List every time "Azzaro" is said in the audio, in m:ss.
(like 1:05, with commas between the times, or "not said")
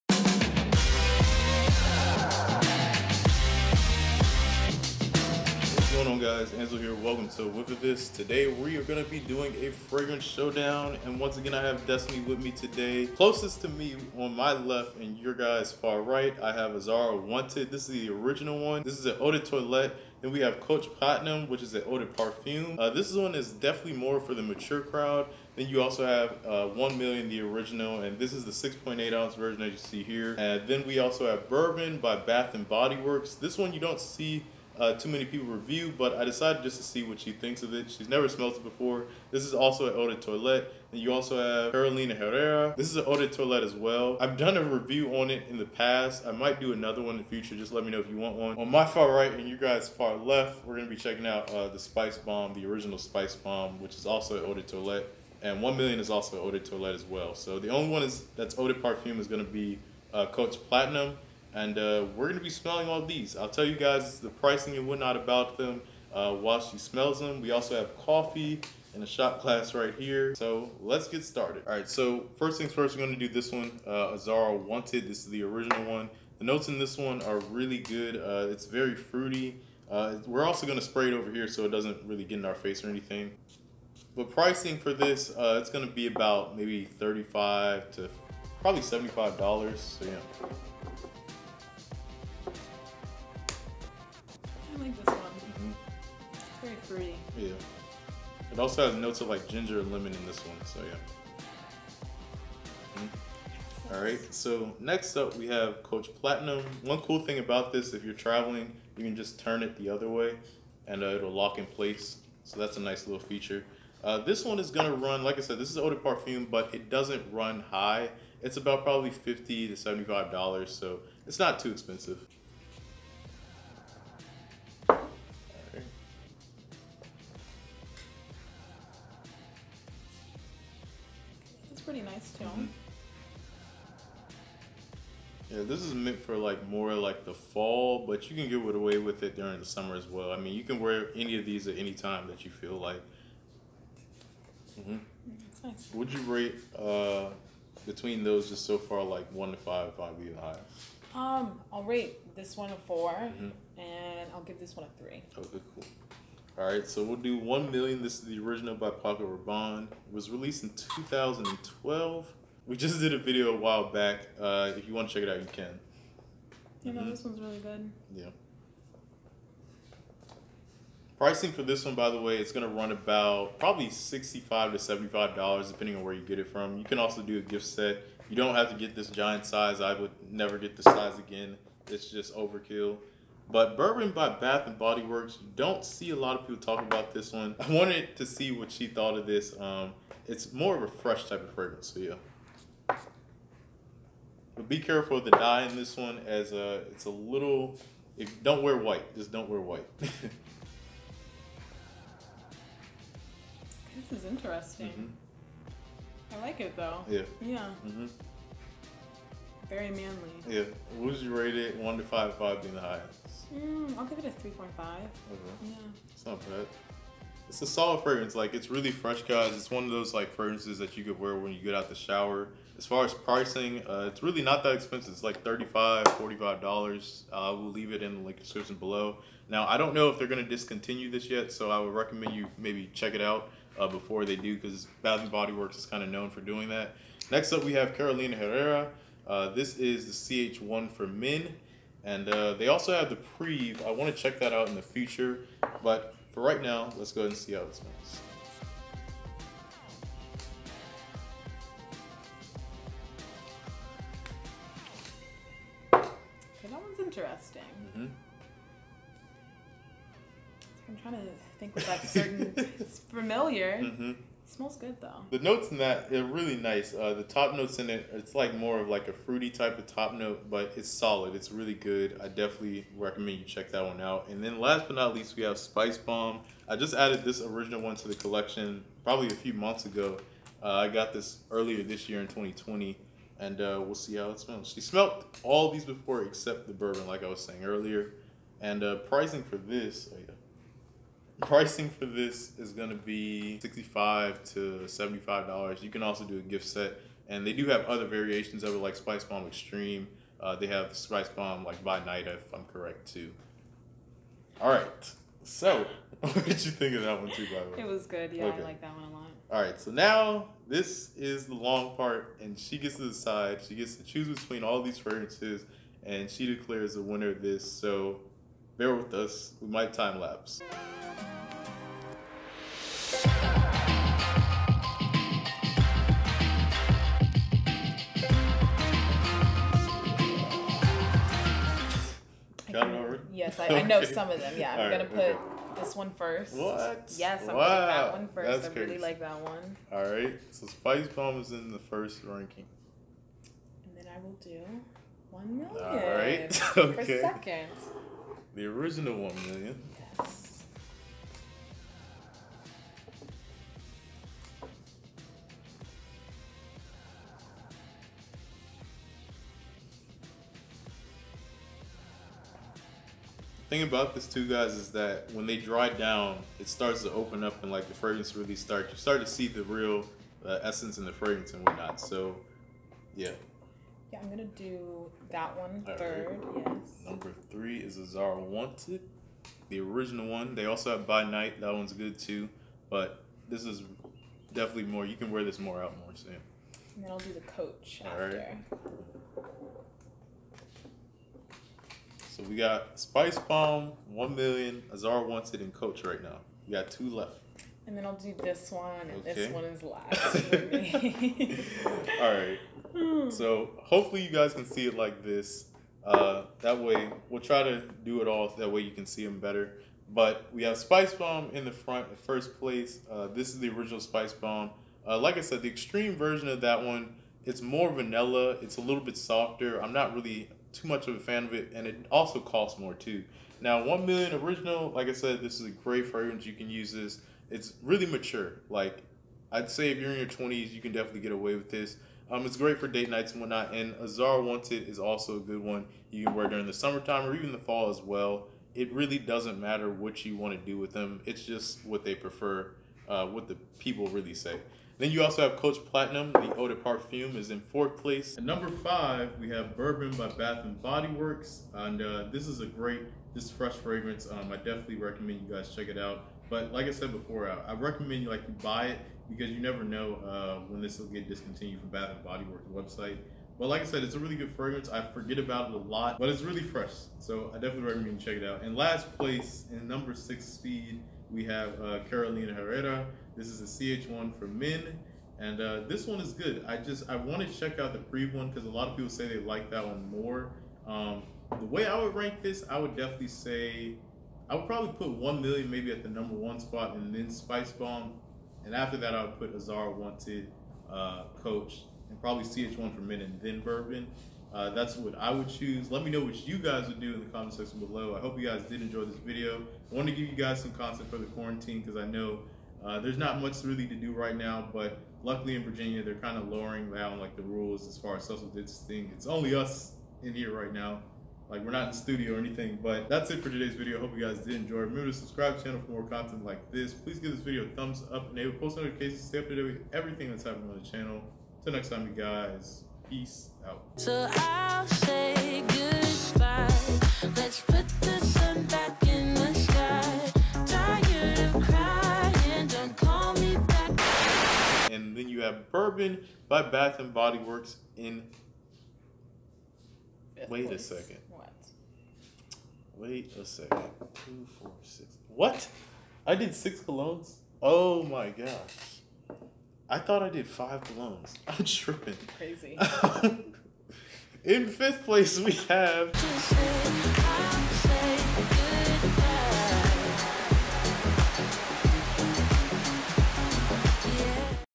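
0:16, 1:14, 6:17, 6:34, 7:13, 8:09.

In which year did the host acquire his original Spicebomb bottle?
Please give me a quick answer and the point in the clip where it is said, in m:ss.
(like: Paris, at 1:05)
2020, at 4:42.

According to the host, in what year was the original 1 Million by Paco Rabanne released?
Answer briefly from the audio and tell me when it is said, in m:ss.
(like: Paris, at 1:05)
2012, at 2:40.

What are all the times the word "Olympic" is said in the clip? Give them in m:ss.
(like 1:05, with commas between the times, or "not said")
not said.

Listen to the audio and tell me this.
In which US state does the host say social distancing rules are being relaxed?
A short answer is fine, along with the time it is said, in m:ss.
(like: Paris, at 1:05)
Virginia, at 8:25.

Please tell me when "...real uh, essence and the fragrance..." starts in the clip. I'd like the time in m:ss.
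6:09.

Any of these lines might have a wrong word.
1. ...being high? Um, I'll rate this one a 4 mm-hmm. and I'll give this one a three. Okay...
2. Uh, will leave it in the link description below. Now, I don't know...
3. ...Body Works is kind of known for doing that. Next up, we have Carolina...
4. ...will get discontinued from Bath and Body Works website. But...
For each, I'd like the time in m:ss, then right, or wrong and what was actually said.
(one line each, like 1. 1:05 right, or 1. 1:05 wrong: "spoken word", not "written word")
1. 2:30 right
2. 3:47 right
3. 3:55 right
4. 7:40 right.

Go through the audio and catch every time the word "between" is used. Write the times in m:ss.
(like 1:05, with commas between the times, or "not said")
2:27, 5:14.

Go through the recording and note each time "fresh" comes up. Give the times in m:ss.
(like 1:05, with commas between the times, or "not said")
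3:10, 3:38, 7:33, 7:46.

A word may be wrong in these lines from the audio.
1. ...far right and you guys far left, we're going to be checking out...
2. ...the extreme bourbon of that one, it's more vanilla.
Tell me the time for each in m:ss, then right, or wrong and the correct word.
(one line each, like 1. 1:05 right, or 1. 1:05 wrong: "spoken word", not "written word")
1. 0:48 right
2. 6:55 wrong: "version", not "bourbon".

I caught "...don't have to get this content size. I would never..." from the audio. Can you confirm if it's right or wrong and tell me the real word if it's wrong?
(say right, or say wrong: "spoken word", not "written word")
wrong: "giant", not "content".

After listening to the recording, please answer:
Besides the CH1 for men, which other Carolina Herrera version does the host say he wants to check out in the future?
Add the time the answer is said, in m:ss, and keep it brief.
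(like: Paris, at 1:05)
Privé, at 4:03.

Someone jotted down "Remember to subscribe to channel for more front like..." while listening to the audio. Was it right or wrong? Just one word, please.
wrong.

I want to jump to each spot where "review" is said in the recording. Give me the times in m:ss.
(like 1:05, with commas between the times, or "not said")
0:35, 0:44.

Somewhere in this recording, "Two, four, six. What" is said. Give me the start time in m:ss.
9:04.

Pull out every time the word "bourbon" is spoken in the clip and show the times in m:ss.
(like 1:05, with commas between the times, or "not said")
0:31, 3:03, 4:46, 7:29, 8:13, 8:55.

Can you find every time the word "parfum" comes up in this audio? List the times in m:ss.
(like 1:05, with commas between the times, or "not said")
0:22, 0:58, 1:55, 7:26.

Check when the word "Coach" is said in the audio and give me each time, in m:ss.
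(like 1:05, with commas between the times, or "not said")
0:20, 1:00, 1:45, 6:27, 6:35, 7:25, 8:11.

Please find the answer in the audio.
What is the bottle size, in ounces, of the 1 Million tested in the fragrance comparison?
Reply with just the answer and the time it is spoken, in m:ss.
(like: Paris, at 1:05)
6.8 ounces, at 0:28.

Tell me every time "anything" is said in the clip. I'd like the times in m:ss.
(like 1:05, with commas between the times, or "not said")
1:22, 8:32.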